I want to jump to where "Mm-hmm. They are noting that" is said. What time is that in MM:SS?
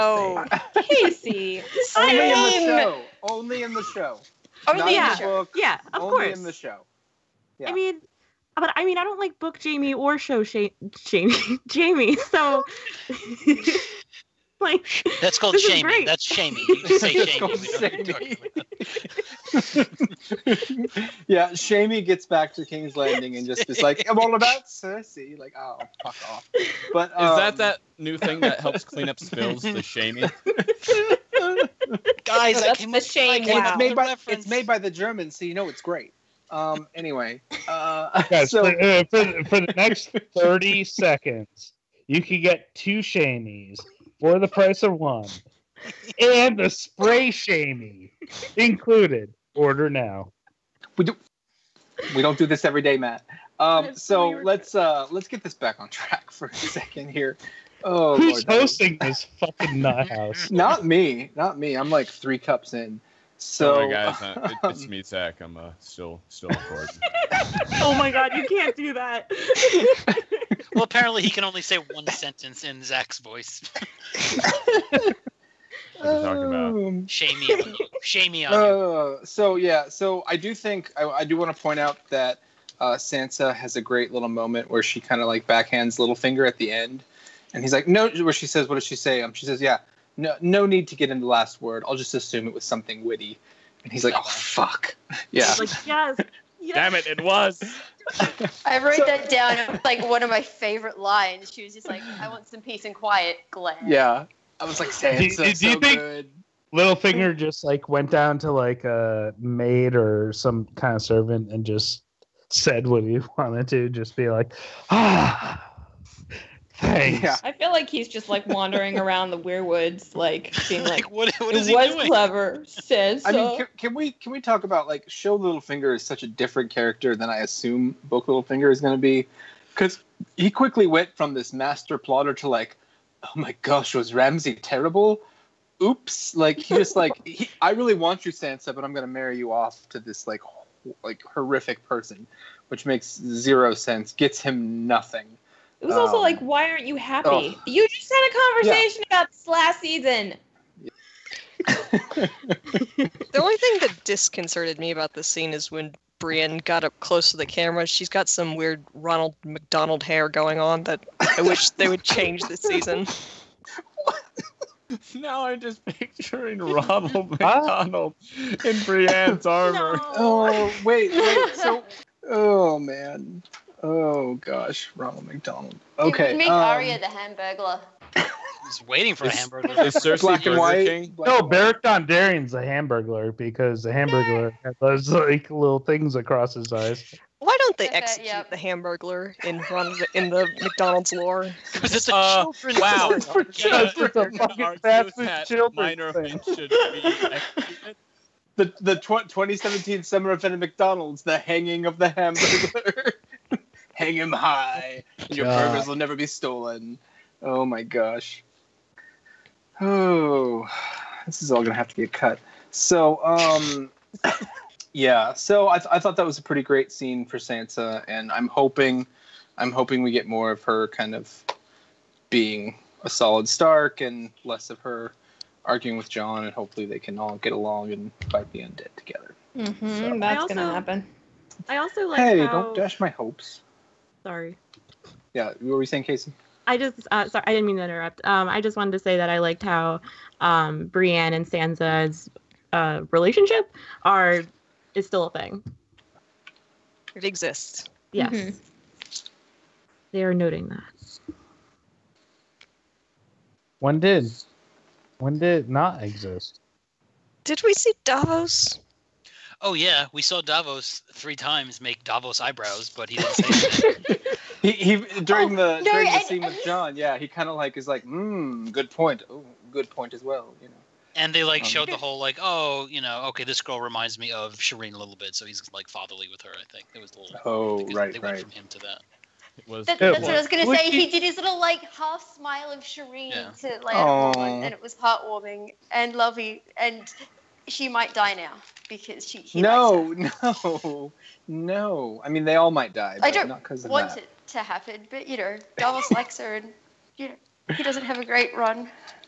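04:08.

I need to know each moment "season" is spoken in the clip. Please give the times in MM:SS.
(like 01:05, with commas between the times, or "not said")
02:29, 02:42.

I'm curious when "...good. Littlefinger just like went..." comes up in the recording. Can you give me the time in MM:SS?
01:45.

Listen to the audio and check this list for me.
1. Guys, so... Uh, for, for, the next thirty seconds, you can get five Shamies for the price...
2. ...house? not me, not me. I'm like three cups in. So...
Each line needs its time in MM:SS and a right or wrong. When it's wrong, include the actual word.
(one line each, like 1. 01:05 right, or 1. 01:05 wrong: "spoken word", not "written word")
1. 00:38 wrong: "two", not "five"
2. 01:00 right.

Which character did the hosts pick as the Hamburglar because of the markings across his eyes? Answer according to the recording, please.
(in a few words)
Beric Dondarrion.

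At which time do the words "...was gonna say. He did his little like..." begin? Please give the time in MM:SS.
04:40.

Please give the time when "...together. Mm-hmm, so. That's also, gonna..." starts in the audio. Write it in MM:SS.
03:48.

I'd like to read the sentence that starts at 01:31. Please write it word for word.
I'll just assume it was something witty.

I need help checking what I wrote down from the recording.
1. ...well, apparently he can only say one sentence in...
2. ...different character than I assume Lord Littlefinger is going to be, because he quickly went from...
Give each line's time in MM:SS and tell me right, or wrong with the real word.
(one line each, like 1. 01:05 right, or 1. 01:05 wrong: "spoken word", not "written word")
1. 01:10 right
2. 02:06 wrong: "Book", not "Lord".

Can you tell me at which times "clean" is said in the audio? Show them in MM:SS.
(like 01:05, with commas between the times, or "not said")
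00:28.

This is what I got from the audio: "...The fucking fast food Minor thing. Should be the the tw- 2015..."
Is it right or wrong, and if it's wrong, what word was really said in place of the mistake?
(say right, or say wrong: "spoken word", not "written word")
wrong: "2017", not "2015".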